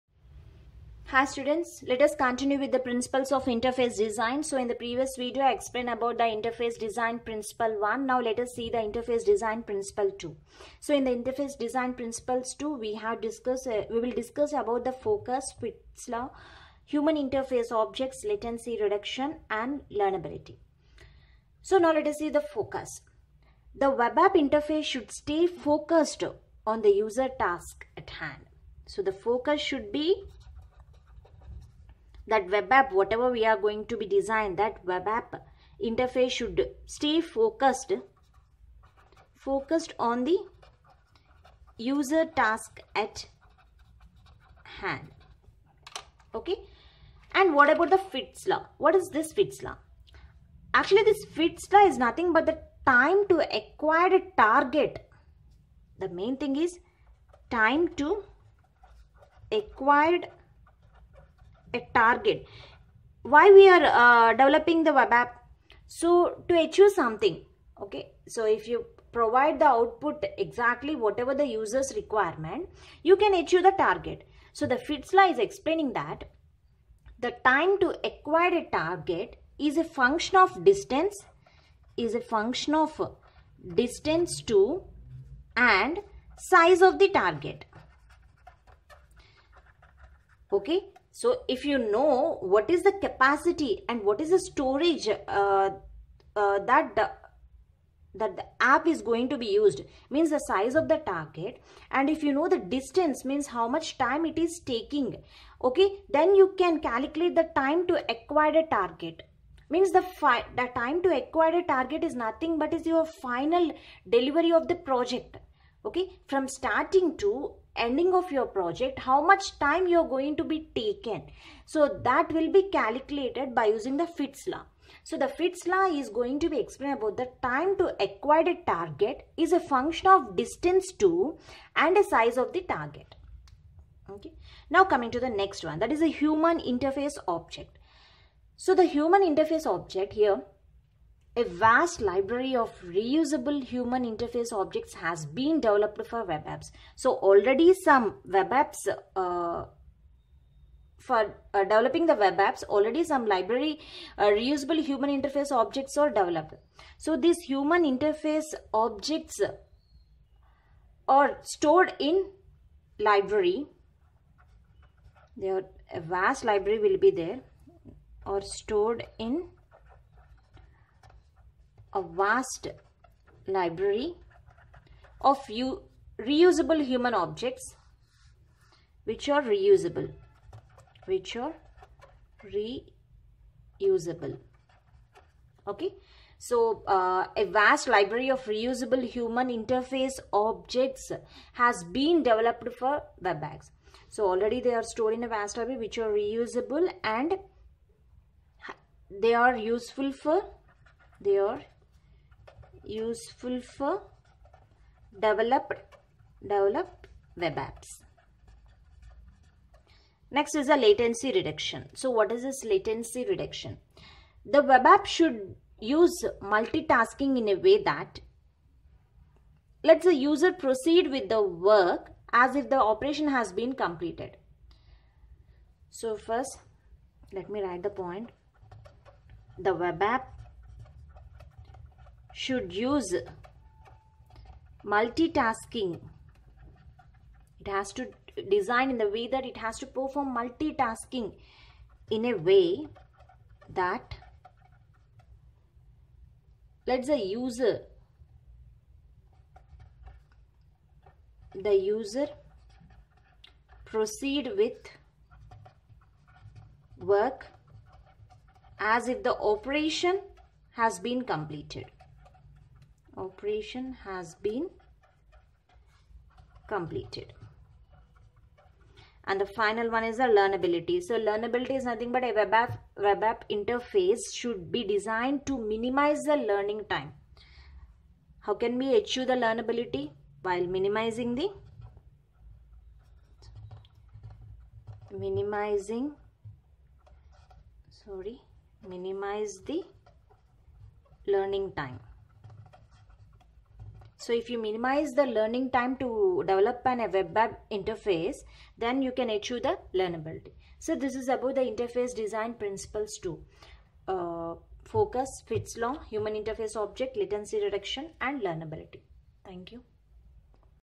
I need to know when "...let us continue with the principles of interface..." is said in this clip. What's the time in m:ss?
0:01.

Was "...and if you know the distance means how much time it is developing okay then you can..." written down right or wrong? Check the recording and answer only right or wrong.
wrong.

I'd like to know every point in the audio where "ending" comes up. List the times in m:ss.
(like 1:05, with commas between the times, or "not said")
1:57.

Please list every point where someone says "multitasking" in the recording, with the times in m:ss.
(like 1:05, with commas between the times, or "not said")
3:36, 3:54, 4:00.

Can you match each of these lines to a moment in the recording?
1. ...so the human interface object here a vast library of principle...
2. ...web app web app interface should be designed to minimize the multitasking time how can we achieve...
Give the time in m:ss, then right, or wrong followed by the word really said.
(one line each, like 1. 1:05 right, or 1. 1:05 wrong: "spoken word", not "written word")
1. 2:18 wrong: "reusable", not "principle"
2. 4:32 wrong: "learning", not "multitasking".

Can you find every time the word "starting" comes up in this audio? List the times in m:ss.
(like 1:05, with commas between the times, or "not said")
1:56.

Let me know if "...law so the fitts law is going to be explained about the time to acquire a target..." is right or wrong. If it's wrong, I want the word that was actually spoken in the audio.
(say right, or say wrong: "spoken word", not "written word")
right.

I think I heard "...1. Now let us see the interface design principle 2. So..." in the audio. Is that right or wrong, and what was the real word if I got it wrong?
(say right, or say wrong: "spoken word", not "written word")
right.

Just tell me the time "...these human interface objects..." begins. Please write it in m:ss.
2:37.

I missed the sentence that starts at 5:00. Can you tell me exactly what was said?
So this is about the interface design principles too.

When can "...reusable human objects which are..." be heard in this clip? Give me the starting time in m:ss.
2:56.